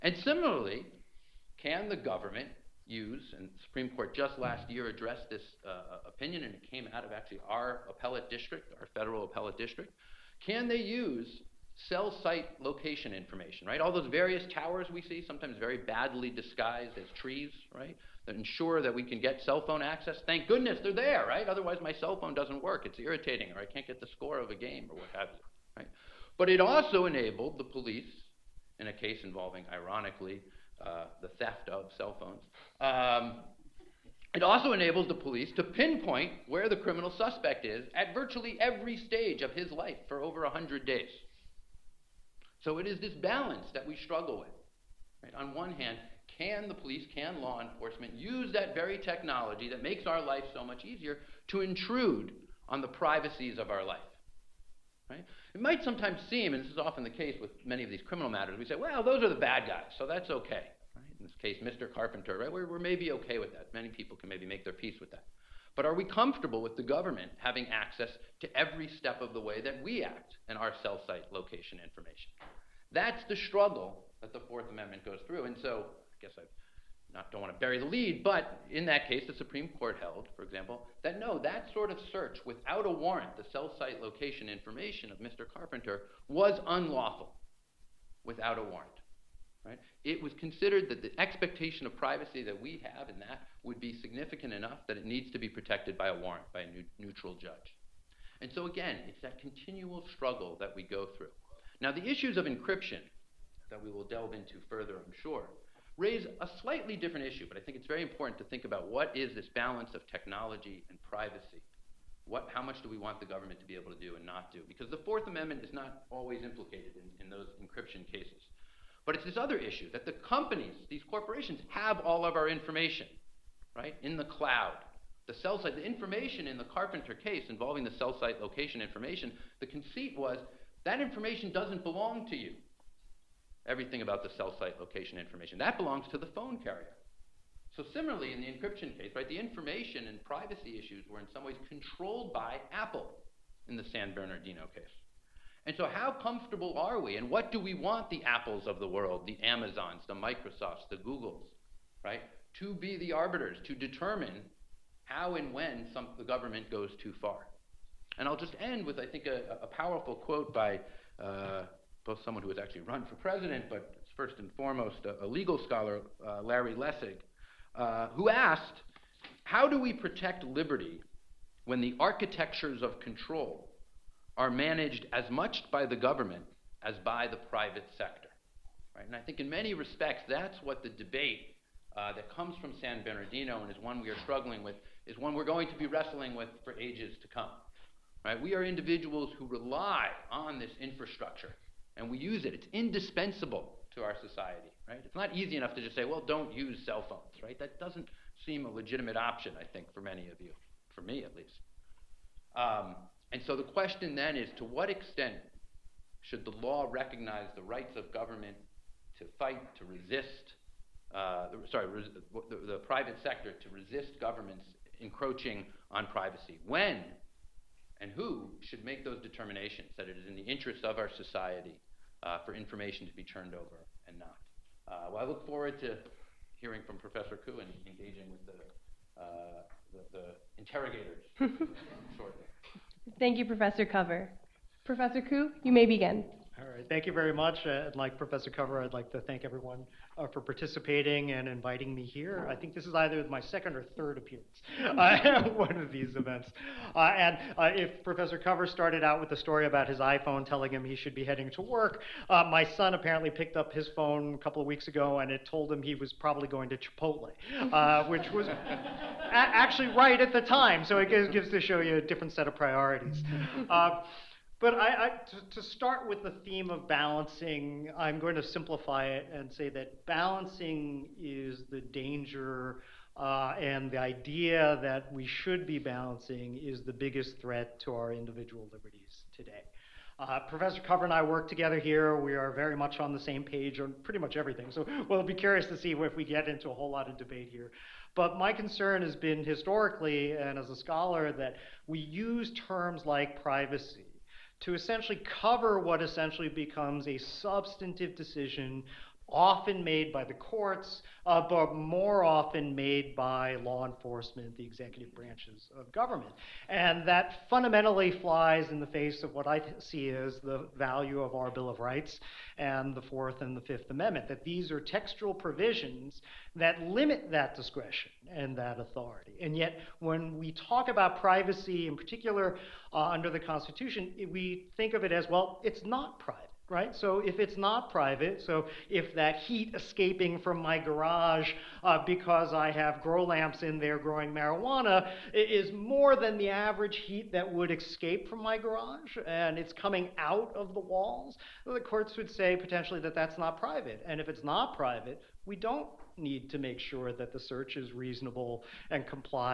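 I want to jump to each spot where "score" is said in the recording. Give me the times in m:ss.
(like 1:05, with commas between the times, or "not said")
0:24.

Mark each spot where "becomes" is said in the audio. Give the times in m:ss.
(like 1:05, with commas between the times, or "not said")
4:56.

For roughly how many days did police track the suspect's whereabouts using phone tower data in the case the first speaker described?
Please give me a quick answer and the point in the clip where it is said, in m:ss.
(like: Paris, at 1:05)
over 100 days, at 0:40.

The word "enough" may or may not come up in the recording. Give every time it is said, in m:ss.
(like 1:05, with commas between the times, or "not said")
1:34, 3:15.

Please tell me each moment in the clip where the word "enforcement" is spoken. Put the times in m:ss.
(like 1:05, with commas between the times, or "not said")
0:47, 5:03.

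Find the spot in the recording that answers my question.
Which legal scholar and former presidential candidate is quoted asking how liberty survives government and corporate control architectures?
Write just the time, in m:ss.
2:46.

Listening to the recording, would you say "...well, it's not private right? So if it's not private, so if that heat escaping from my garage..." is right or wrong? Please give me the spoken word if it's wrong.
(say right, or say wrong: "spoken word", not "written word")
right.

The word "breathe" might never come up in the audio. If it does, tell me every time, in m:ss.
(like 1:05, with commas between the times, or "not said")
not said.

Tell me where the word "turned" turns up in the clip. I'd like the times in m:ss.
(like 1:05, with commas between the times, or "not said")
3:43.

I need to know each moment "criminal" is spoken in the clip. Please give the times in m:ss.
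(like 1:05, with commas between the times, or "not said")
0:36, 0:58.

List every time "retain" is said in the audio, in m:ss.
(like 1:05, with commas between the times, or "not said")
not said.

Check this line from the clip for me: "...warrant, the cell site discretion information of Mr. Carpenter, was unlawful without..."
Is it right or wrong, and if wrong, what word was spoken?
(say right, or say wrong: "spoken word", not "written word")
wrong: "location", not "discretion".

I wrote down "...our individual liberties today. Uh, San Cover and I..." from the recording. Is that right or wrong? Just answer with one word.
wrong.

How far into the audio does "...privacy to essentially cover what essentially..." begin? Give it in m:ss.
4:53.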